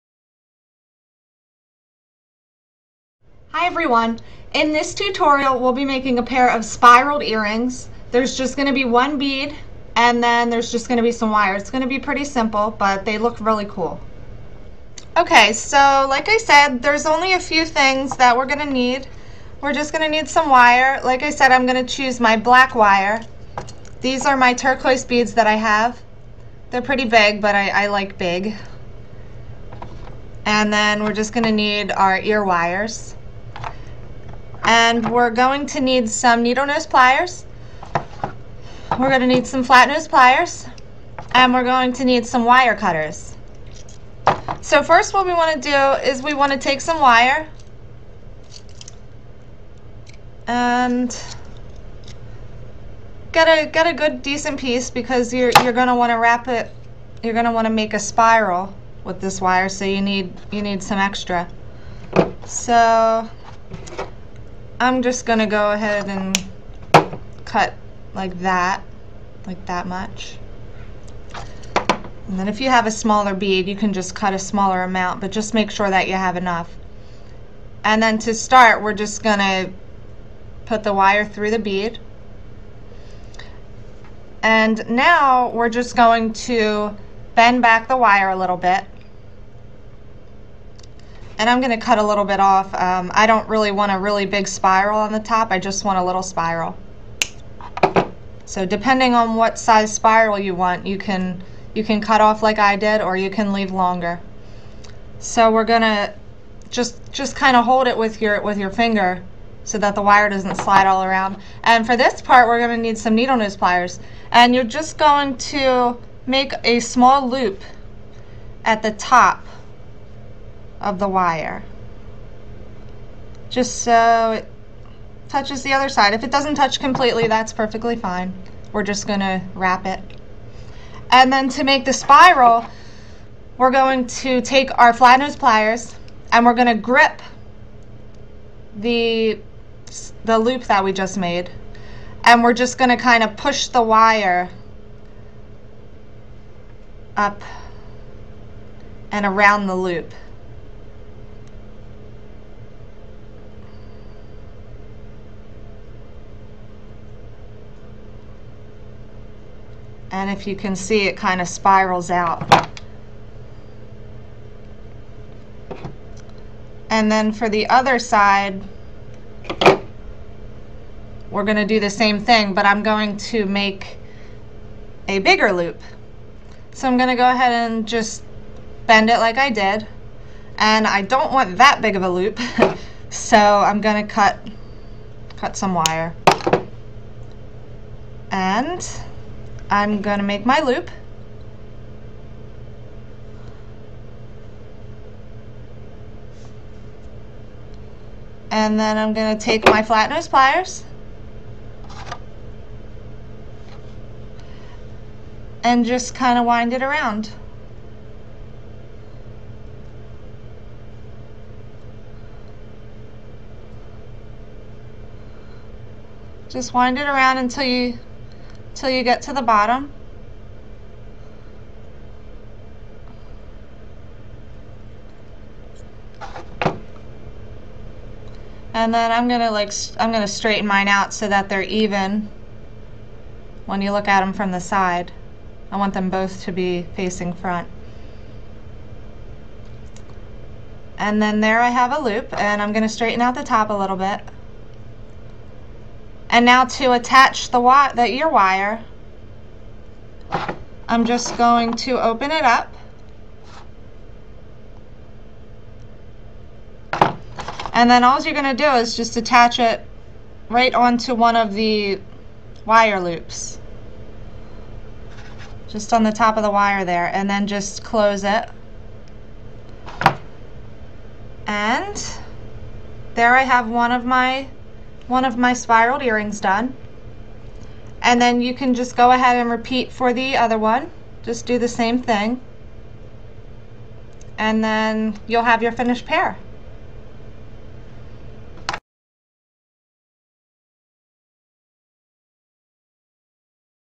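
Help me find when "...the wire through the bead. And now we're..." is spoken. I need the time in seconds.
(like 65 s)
80 s.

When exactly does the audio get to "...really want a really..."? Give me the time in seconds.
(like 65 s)
93 s.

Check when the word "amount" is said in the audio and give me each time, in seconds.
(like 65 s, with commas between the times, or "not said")
74 s.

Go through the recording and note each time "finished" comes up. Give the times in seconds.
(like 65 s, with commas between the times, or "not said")
285 s.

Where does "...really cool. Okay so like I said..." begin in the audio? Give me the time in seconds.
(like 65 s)
13 s.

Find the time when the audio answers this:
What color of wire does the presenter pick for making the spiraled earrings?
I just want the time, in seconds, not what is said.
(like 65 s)
22 s.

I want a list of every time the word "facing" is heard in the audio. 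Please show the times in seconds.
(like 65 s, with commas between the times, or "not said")
236 s.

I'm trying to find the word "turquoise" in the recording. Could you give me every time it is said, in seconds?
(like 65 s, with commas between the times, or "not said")
24 s.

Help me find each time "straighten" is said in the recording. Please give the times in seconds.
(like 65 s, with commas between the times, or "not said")
230 s, 242 s.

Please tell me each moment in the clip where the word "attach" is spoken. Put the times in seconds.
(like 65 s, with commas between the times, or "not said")
246 s, 259 s.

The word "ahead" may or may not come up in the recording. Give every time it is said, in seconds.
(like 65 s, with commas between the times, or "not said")
65 s, 177 s, 279 s.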